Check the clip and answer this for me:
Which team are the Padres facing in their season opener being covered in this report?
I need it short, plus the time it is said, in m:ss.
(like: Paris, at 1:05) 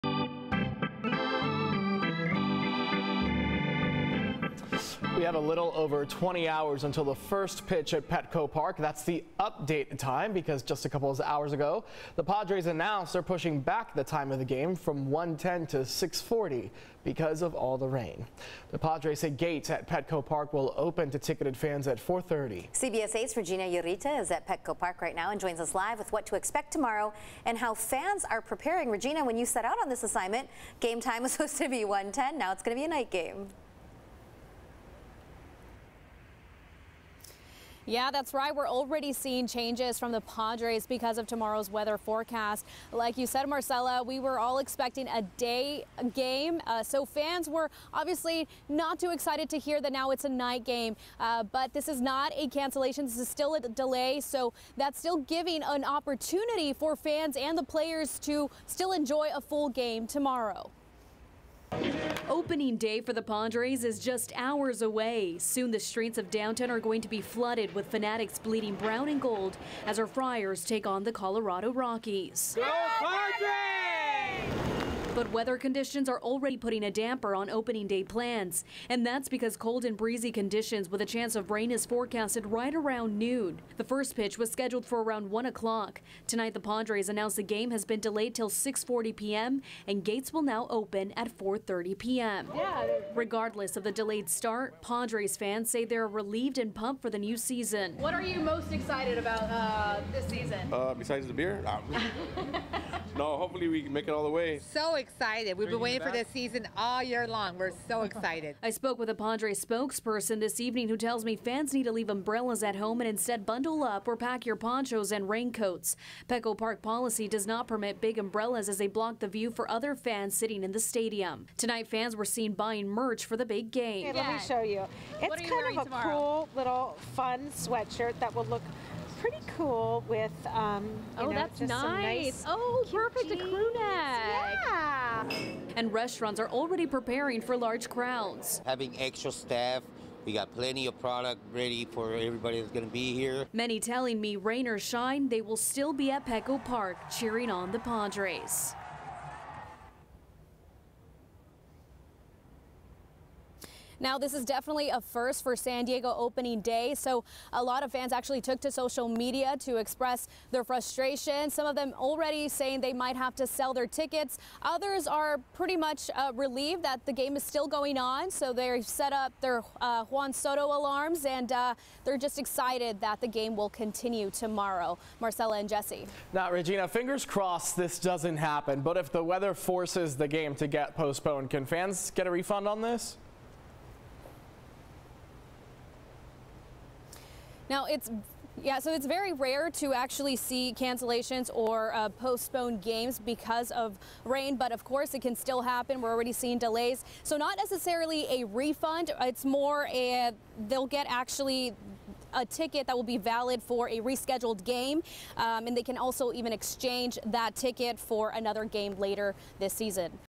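Colorado Rockies, at 1:11.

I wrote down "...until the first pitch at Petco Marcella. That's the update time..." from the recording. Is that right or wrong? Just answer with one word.
wrong.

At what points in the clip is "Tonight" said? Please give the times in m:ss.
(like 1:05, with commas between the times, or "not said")
1:26, 2:01.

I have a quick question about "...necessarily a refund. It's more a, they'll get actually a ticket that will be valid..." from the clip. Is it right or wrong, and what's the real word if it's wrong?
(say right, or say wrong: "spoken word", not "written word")
right.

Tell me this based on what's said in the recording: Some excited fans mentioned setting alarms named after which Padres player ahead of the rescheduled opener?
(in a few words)
Juan Soto.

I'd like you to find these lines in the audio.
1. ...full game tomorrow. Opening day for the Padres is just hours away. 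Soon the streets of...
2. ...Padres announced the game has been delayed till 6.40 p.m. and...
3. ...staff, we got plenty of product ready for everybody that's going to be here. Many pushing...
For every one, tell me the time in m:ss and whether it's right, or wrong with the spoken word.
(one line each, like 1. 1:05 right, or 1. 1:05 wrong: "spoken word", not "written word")
1. 0:59 right
2. 1:26 right
3. 2:19 wrong: "telling", not "pushing".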